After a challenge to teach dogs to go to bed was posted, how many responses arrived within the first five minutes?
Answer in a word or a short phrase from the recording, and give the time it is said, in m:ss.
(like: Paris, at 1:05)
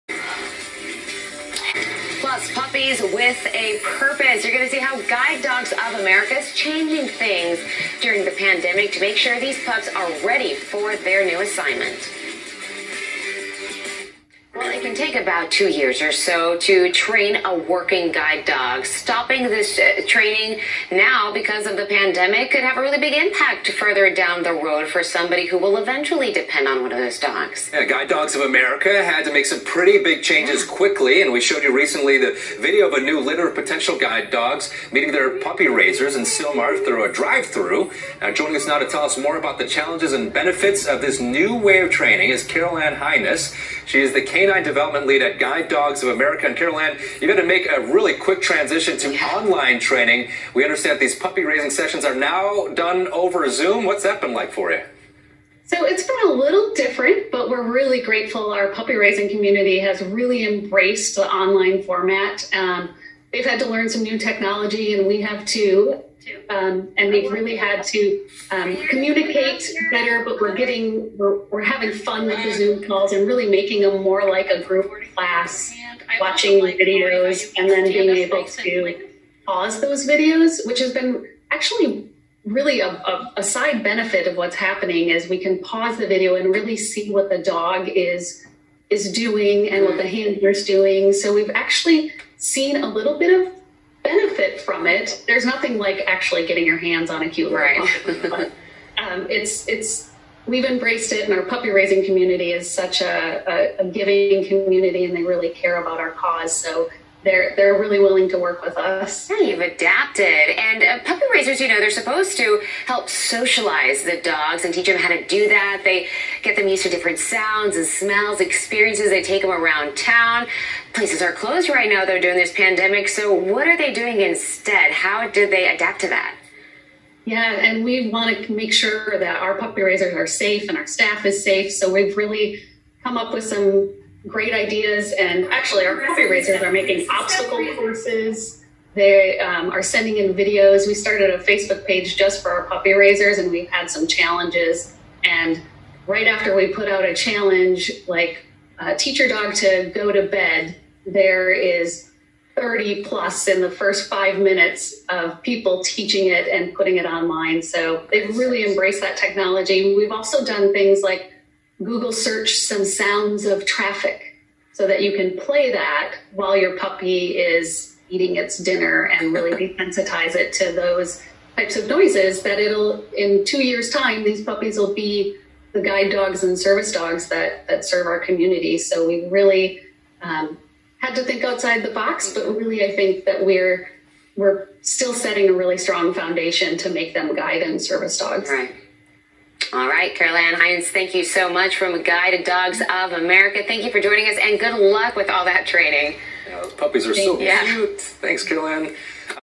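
30 plus, at 2:32.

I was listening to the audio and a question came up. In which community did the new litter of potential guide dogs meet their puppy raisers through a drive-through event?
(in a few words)
Sylmar.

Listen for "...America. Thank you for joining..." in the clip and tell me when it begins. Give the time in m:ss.
3:13.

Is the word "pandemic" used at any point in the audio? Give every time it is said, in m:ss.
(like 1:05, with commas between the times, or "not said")
0:08, 0:21, 2:02.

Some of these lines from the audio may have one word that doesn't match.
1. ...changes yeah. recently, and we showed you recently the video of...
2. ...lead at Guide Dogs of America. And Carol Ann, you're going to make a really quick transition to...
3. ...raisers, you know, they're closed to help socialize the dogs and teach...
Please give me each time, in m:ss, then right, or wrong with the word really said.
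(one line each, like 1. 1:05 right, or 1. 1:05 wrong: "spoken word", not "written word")
1. 0:30 wrong: "quickly", not "recently"
2. 0:45 right
3. 1:51 wrong: "supposed", not "closed".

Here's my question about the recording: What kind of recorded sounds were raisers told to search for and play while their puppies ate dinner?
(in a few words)
traffic.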